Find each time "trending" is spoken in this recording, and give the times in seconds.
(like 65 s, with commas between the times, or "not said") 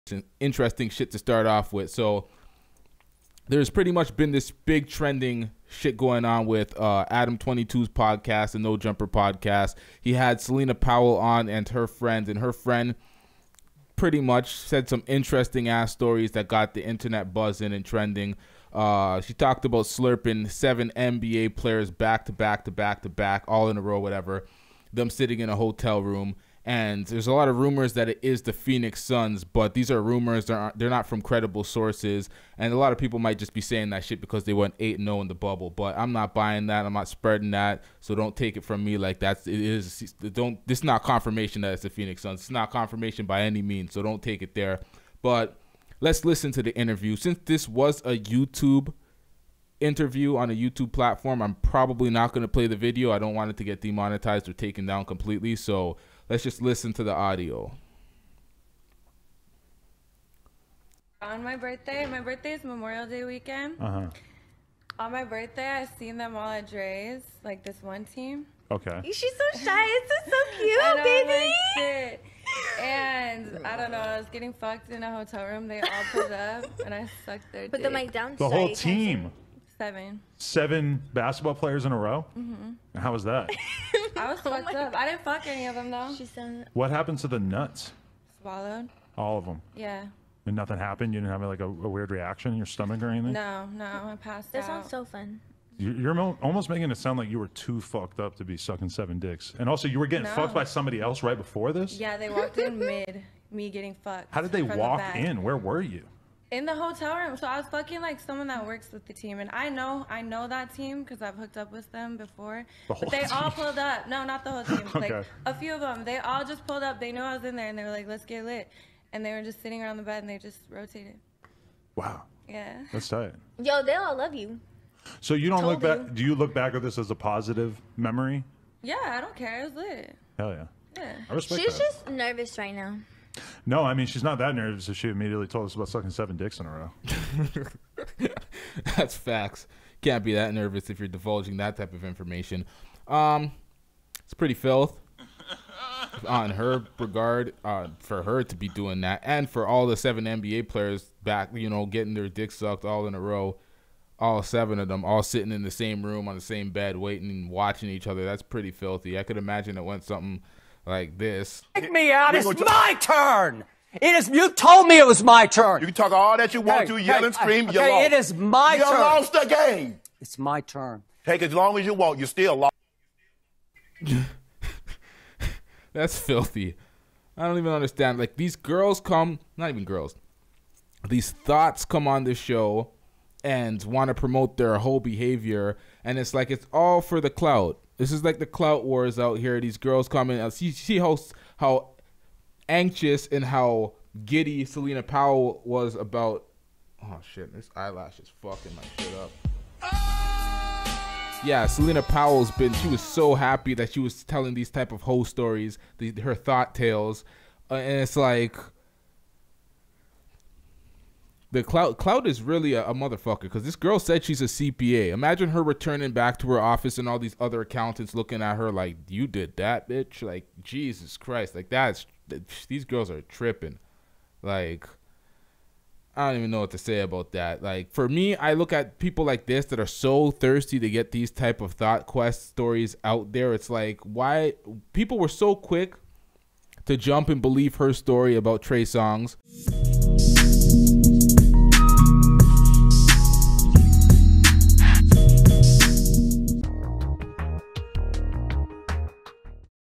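4 s, 17 s.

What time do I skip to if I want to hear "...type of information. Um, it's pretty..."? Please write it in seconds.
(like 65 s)
141 s.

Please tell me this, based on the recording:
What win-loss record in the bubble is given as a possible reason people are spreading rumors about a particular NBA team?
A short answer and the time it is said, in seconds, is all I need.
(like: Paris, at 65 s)
8-0, at 34 s.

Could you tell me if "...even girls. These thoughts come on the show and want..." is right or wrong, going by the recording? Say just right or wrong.
right.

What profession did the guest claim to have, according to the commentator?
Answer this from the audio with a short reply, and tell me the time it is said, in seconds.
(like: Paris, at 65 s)
CPA, at 214 s.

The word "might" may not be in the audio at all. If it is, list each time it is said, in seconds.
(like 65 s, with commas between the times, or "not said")
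33 s.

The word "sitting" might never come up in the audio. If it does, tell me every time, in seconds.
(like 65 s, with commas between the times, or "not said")
25 s, 119 s, 155 s.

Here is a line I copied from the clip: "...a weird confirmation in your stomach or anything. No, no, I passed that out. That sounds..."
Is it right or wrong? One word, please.
wrong.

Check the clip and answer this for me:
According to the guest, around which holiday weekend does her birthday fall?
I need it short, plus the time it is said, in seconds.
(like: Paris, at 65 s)
Memorial Day weekend, at 62 s.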